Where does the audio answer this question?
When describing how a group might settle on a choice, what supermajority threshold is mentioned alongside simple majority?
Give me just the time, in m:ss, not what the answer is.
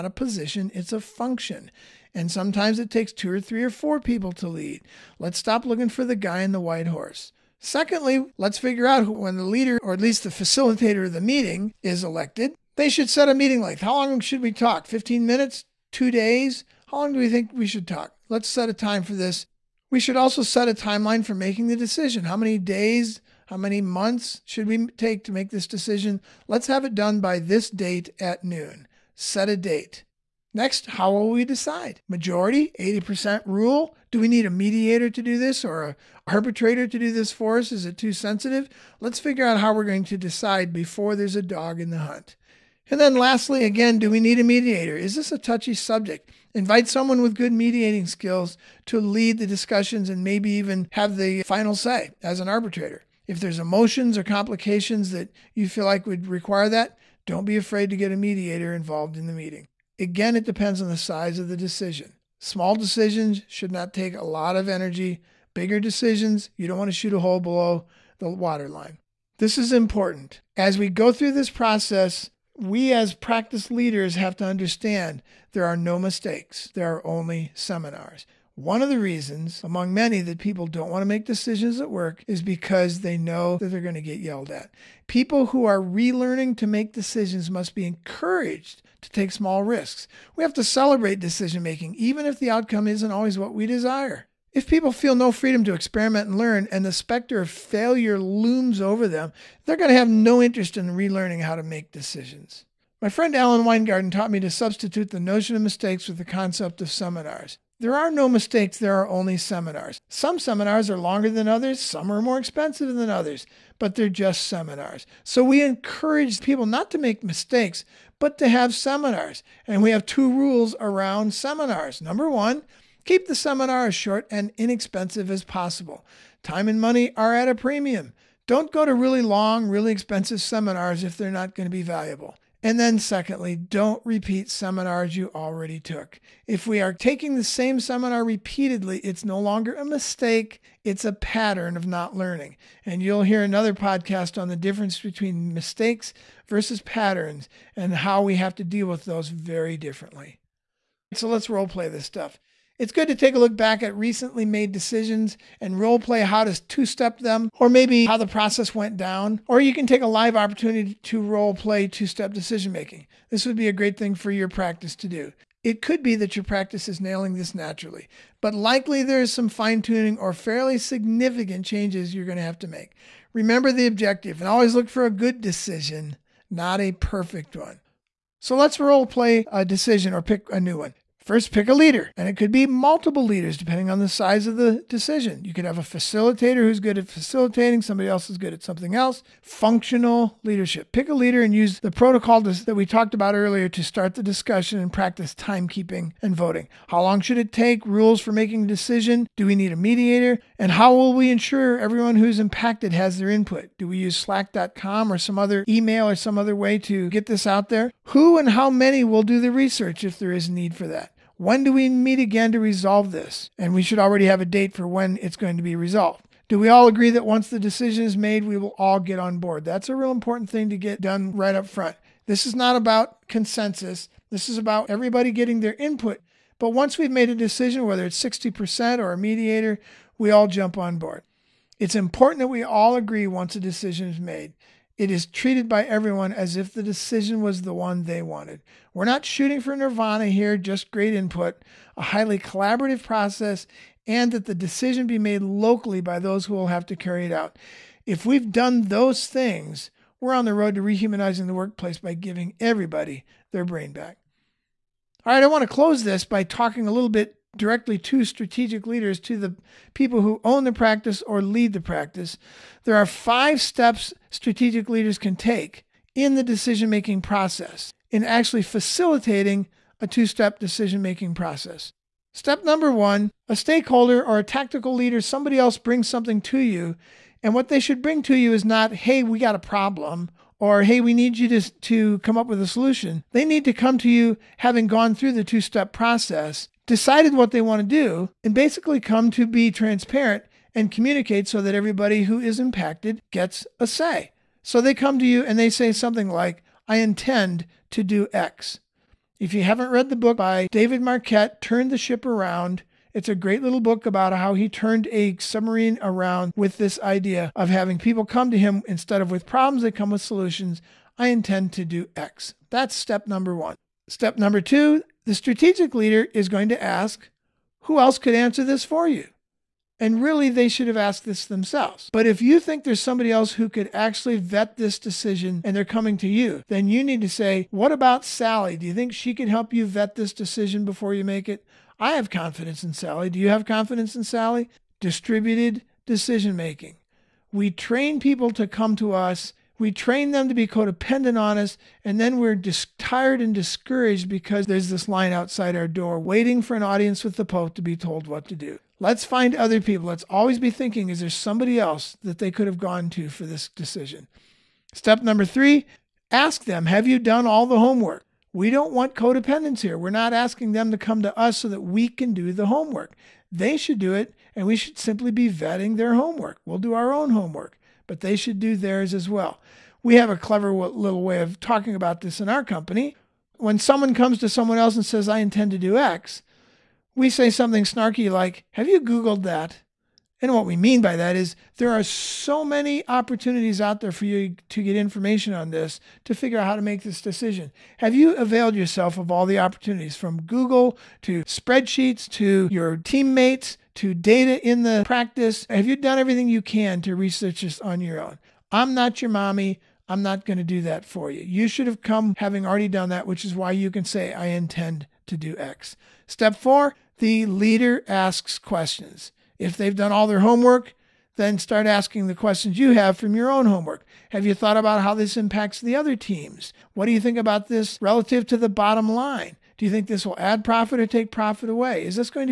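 0:32.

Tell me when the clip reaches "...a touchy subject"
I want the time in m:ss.
0:45.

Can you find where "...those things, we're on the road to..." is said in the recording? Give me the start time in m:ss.
4:08.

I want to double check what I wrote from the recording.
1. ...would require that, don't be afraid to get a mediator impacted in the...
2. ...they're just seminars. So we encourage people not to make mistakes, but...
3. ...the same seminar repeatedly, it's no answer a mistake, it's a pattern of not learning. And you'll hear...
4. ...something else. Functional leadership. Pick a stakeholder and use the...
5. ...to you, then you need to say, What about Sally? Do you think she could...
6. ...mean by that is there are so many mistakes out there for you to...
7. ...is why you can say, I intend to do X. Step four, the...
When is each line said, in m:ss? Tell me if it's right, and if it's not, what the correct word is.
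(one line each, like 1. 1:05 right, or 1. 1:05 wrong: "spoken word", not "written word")
1. 0:56 wrong: "involved", not "impacted"
2. 1:53 right
3. 2:17 wrong: "longer", not "answer"
4. 3:08 wrong: "leader", not "stakeholder"
5. 5:26 right
6. 6:20 wrong: "opportunities", not "mistakes"
7. 6:43 right.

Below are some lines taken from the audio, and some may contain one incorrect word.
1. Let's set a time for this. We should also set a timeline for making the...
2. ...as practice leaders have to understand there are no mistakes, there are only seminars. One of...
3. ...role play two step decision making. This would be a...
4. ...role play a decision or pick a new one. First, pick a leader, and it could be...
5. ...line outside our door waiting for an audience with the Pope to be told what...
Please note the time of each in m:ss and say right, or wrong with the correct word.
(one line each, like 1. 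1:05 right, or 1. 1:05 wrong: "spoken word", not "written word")
1. 0:18 right
2. 1:12 right
3. 2:41 right
4. 2:58 right
5. 5:45 right.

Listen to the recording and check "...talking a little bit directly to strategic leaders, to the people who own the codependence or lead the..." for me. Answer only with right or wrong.
wrong.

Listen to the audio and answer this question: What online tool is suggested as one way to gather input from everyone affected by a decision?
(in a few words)
slack.com.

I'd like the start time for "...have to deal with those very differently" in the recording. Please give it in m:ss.
2:28.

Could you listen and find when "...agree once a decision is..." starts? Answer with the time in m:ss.
3:52.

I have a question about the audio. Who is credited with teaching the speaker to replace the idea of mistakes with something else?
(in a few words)
Alan Weingarten.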